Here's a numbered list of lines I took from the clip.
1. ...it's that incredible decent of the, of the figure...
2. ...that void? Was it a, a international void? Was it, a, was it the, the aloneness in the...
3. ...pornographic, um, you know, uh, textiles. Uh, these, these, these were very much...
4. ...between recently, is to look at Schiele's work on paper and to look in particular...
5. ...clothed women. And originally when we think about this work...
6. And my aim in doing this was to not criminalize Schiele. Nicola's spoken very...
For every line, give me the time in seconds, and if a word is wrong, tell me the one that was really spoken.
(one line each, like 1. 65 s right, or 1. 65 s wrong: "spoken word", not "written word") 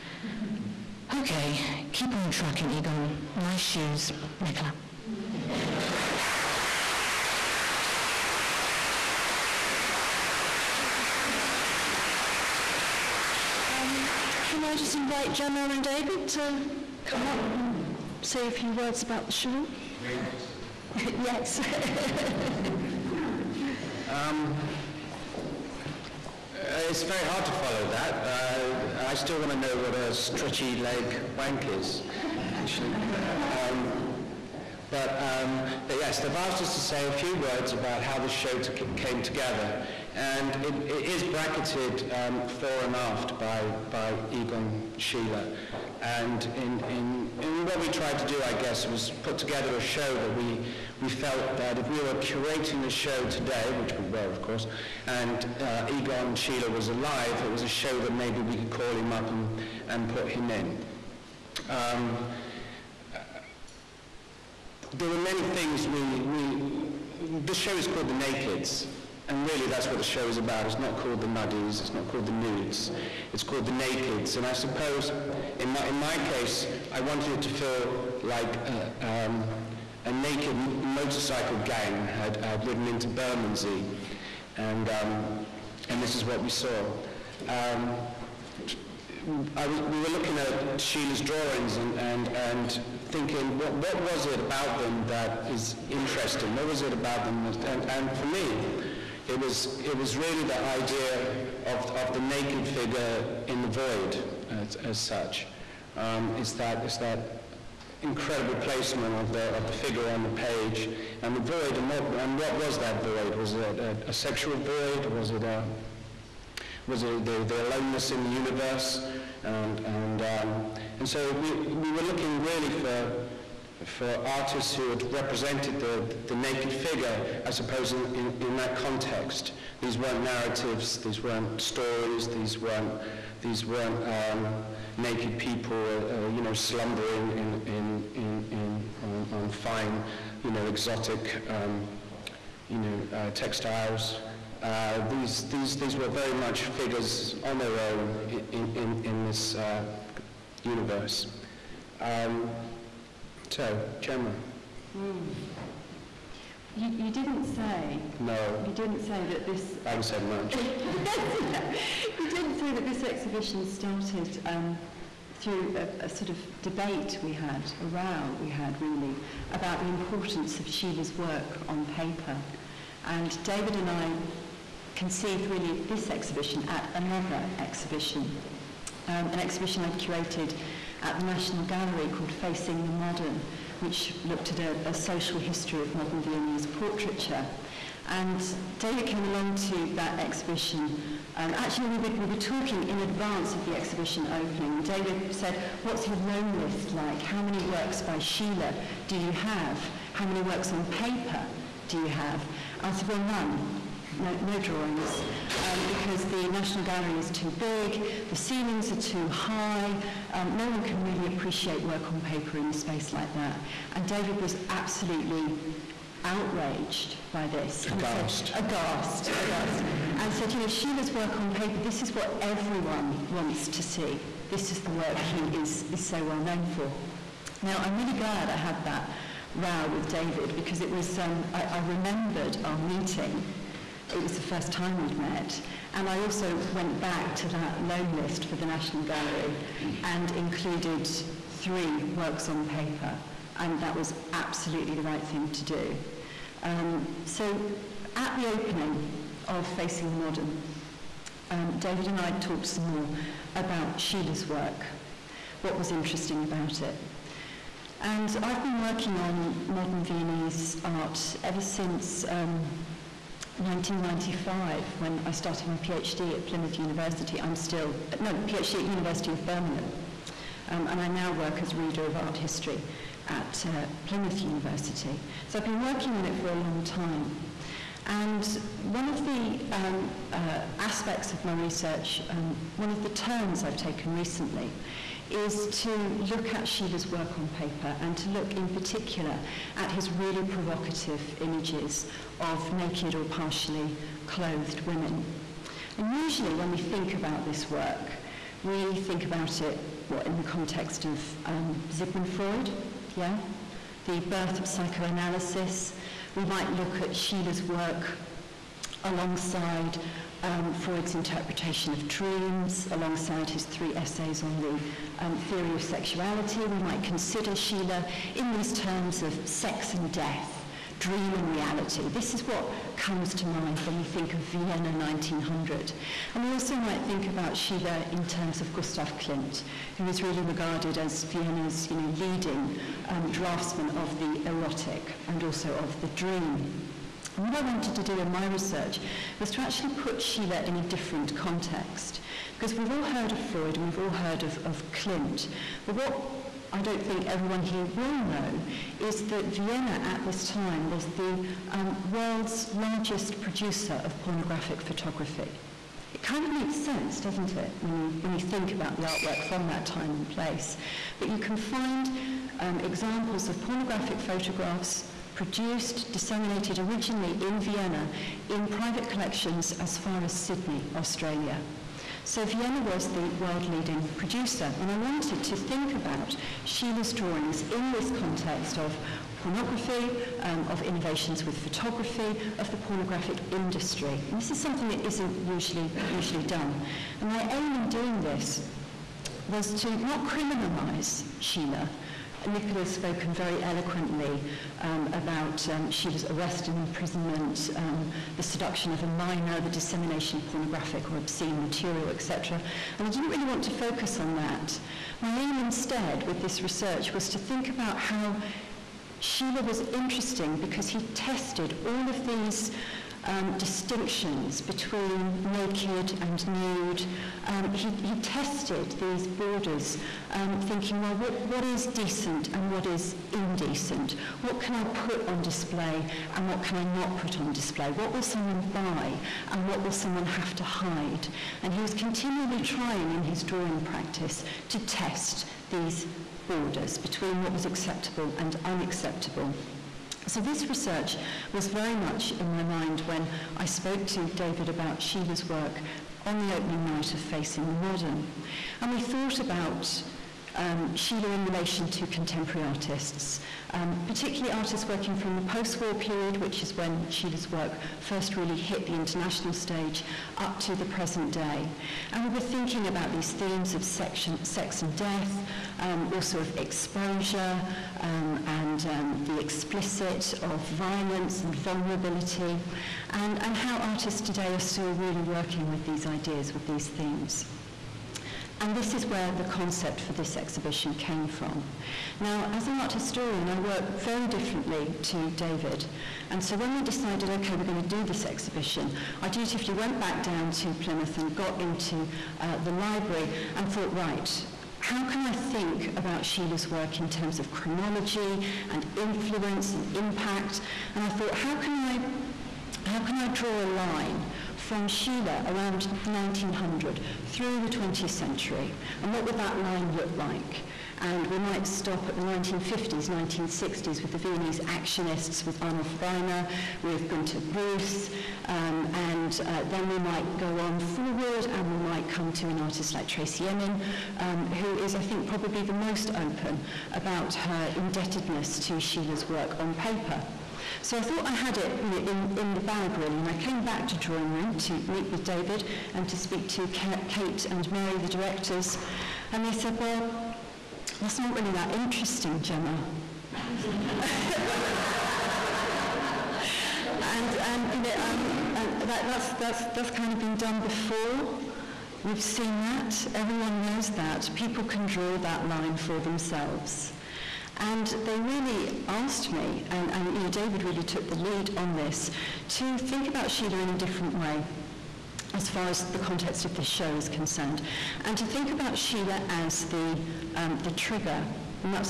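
1. 106 s wrong: "placement", not "decent"
2. 112 s wrong: "sexual", not "international"
3. 140 s wrong: "exotic", not "pornographic"
4. 283 s wrong: "taken", not "between"
5. 294 s wrong: "usually", not "originally"
6. 387 s right.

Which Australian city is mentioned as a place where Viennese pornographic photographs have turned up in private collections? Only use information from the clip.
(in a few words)
Sydney.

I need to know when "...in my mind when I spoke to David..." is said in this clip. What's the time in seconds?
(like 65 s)
442 s.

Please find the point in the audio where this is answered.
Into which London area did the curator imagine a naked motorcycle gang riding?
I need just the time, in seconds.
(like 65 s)
83 s.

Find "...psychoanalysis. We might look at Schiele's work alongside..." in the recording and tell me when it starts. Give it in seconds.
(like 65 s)
304 s.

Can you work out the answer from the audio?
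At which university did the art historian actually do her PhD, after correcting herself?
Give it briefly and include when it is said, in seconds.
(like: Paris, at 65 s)
University of Birmingham, at 268 s.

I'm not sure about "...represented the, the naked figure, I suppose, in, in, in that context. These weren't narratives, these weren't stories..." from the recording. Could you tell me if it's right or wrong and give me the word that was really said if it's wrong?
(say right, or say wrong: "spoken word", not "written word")
right.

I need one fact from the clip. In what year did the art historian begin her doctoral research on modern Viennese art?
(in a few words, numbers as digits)
1995.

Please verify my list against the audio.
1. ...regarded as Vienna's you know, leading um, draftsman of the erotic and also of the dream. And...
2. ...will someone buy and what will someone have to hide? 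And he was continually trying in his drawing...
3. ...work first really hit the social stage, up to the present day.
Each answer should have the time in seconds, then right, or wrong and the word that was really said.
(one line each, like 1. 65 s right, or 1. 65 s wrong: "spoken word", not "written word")
1. 330 s right
2. 428 s right
3. 457 s wrong: "international", not "social".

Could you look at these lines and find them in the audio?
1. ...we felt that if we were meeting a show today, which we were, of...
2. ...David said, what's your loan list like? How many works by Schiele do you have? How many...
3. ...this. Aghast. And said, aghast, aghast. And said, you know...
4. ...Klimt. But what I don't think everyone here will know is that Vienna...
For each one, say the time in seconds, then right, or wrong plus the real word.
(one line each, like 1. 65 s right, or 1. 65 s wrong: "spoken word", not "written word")
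1. 51 s wrong: "curating", not "meeting"
2. 194 s right
3. 217 s right
4. 344 s right.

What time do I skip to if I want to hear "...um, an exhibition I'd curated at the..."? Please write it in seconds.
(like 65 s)
179 s.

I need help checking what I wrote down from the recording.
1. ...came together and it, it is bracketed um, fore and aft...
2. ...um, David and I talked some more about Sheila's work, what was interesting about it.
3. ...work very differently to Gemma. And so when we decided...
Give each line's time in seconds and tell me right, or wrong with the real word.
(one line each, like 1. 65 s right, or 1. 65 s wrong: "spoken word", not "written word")
1. 38 s right
2. 251 s right
3. 483 s wrong: "David", not "Gemma".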